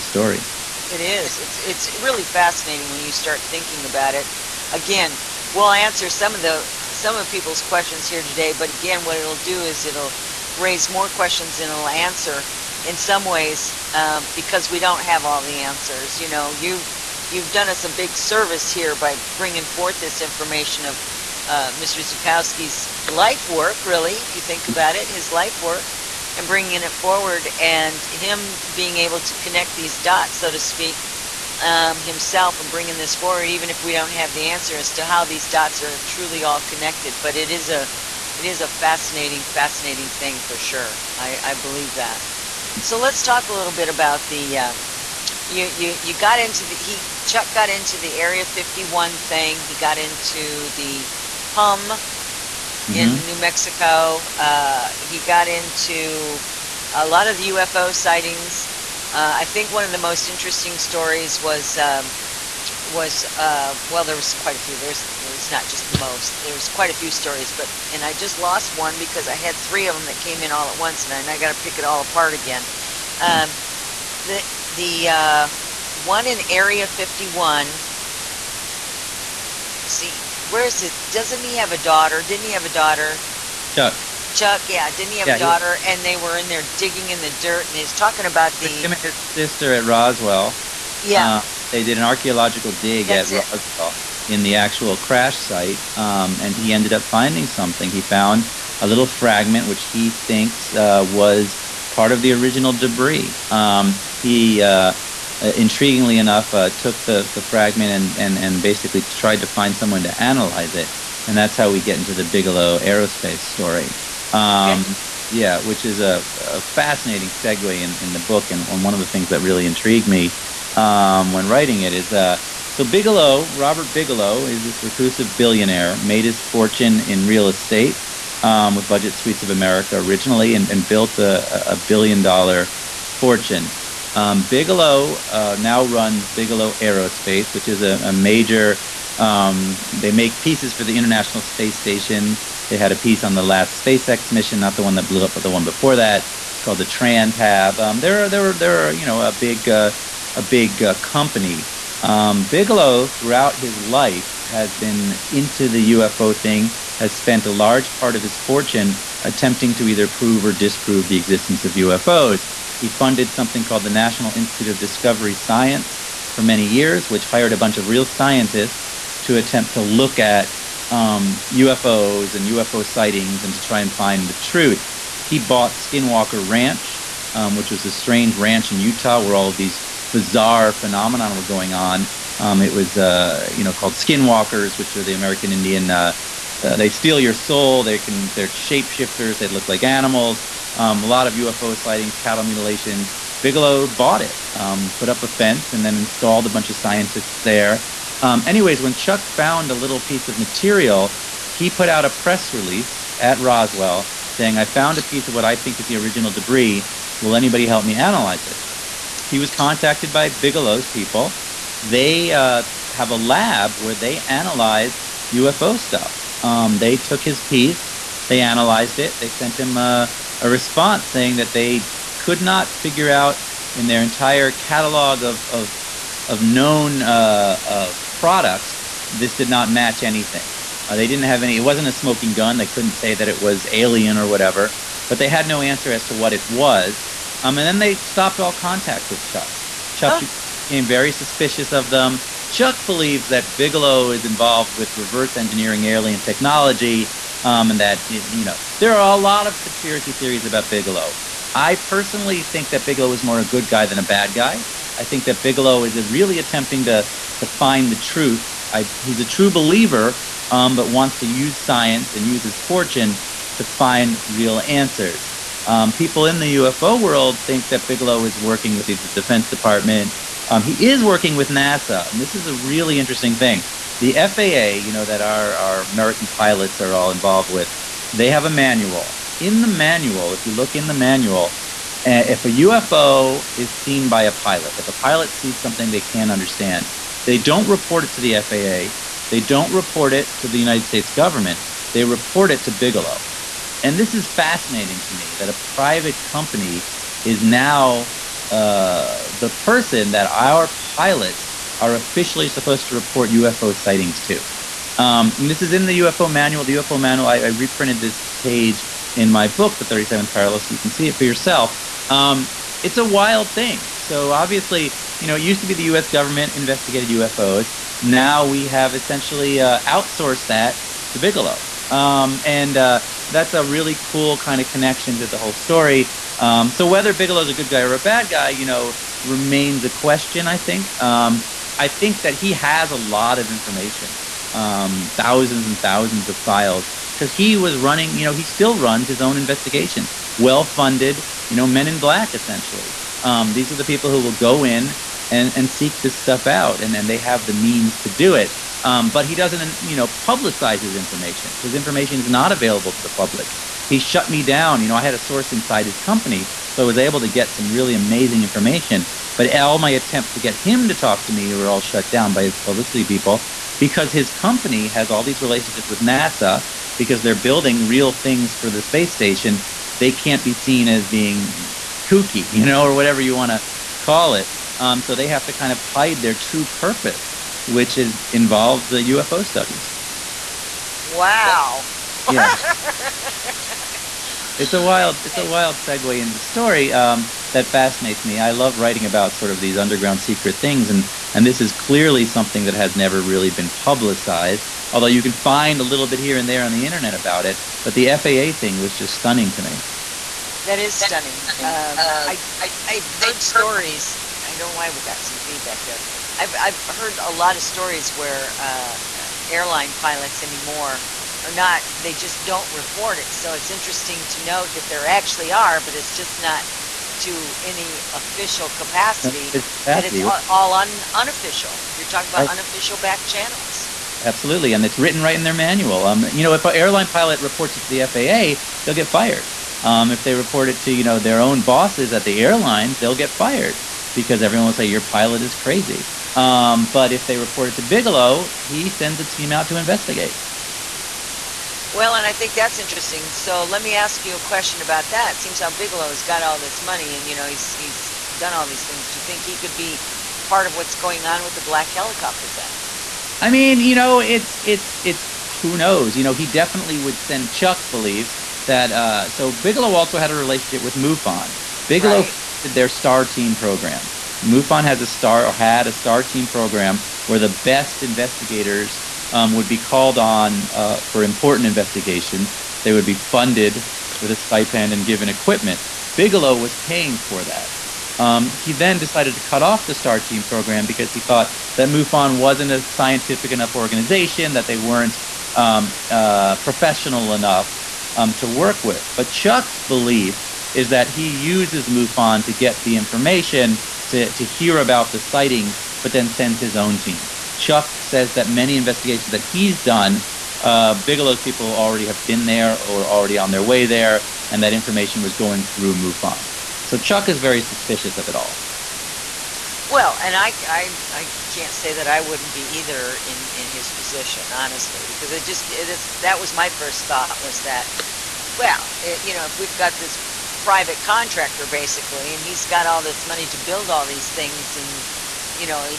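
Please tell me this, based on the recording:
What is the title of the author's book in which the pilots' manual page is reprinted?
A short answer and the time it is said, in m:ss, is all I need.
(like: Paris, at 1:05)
The 37th Parallel, at 5:09.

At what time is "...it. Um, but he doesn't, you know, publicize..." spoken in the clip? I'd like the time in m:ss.
5:48.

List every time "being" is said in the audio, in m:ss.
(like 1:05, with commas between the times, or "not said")
0:28, 6:11.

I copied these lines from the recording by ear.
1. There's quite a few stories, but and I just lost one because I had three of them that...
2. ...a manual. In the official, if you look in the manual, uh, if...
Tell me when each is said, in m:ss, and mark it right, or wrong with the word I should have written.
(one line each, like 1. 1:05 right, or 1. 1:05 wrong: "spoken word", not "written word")
1. 1:06 right
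2. 4:38 wrong: "manual", not "official".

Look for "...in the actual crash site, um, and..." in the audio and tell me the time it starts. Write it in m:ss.
1:34.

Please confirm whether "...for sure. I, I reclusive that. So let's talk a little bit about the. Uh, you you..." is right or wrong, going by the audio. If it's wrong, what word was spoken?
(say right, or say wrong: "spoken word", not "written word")
wrong: "believe", not "reclusive".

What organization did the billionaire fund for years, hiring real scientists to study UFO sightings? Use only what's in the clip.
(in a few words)
National Institute of Discovery Science.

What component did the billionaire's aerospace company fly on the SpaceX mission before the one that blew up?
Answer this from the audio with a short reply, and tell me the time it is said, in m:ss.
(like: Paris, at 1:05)
Transhab, at 2:26.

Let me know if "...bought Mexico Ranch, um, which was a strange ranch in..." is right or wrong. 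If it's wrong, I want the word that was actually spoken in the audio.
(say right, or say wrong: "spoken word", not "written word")
wrong: "Skinwalker", not "Mexico".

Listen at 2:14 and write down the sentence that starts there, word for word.
Um, Bigelow uh, now runs Bigelow Aerospace, which is a, a major.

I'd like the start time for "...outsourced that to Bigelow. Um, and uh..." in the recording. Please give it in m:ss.
5:19.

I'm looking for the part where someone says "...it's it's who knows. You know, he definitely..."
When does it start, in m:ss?
7:34.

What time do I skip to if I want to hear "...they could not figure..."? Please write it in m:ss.
3:41.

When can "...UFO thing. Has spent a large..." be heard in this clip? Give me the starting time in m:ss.
2:35.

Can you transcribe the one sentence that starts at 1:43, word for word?
Um, he uh, uh, intriguingly enough, uh, took the, the fragment and, and, and basically tried to find someone to analyze it.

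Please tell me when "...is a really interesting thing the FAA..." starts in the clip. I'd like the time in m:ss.
4:32.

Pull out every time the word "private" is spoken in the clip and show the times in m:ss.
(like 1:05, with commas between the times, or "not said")
4:55, 8:40.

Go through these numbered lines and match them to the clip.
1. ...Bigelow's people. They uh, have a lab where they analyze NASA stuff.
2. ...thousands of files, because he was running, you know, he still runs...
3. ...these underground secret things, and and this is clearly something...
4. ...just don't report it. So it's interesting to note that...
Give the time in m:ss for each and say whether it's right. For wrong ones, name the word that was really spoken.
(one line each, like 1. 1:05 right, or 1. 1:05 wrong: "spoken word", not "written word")
1. 3:30 wrong: "UFO", not "NASA"
2. 5:35 right
3. 6:29 right
4. 6:52 right.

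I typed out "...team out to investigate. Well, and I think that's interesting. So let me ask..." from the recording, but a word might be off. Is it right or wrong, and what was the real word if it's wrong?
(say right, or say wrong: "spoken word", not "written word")
right.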